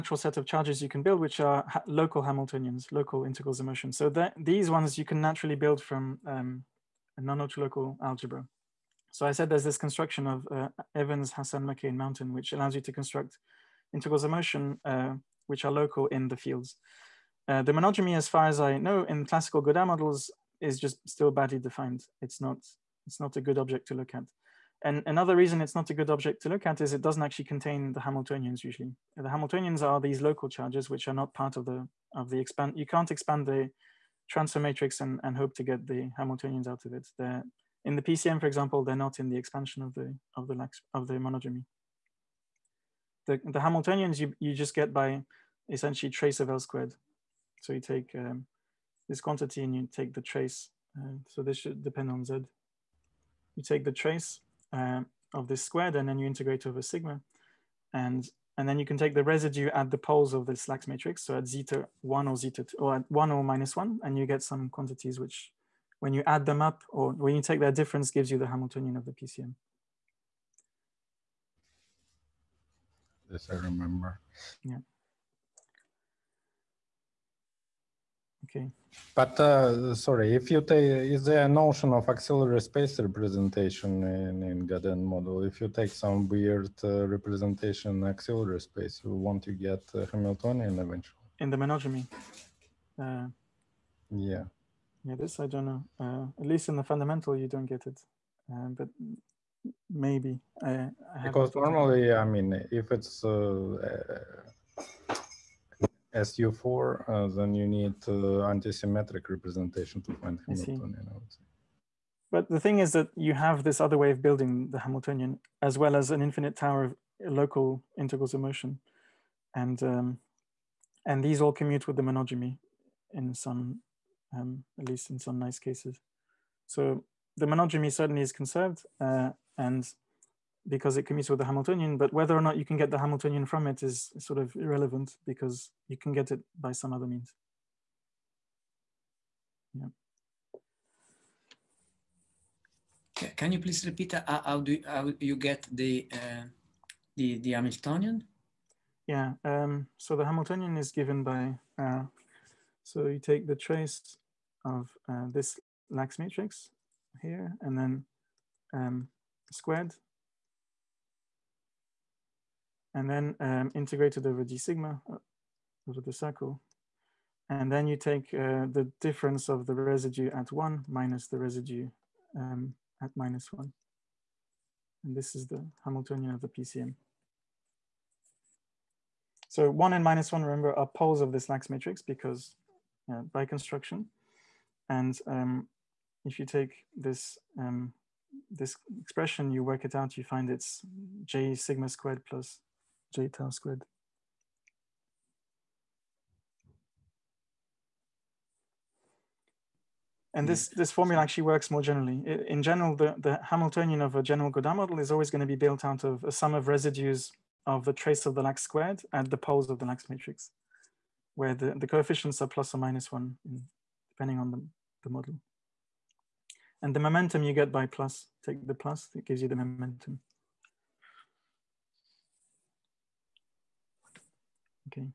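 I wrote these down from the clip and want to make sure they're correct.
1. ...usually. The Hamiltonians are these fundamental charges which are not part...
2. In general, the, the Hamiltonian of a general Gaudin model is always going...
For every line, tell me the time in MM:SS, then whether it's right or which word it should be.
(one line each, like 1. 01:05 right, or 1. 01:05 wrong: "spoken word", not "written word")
1. 00:28 wrong: "local", not "fundamental"
2. 03:22 right.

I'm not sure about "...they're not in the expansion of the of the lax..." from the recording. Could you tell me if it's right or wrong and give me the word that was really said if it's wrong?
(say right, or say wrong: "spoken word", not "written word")
right.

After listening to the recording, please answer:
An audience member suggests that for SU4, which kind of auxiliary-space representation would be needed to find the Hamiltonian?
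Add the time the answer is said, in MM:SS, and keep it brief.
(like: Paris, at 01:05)
Antisymmetric representation, at 01:48.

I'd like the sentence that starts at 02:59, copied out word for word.
So one and minus one, remember, are poles of this Lax matrix because uh, by construction.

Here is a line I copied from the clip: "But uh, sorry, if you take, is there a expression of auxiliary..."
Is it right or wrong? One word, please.
wrong.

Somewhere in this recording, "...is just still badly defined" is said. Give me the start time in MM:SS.
00:20.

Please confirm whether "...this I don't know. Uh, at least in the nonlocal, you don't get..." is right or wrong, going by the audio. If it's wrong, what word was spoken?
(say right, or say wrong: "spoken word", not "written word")
wrong: "fundamental", not "nonlocal".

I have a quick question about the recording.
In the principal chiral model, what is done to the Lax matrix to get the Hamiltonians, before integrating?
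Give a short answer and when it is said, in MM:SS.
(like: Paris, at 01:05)
Trace of L squared, at 00:46.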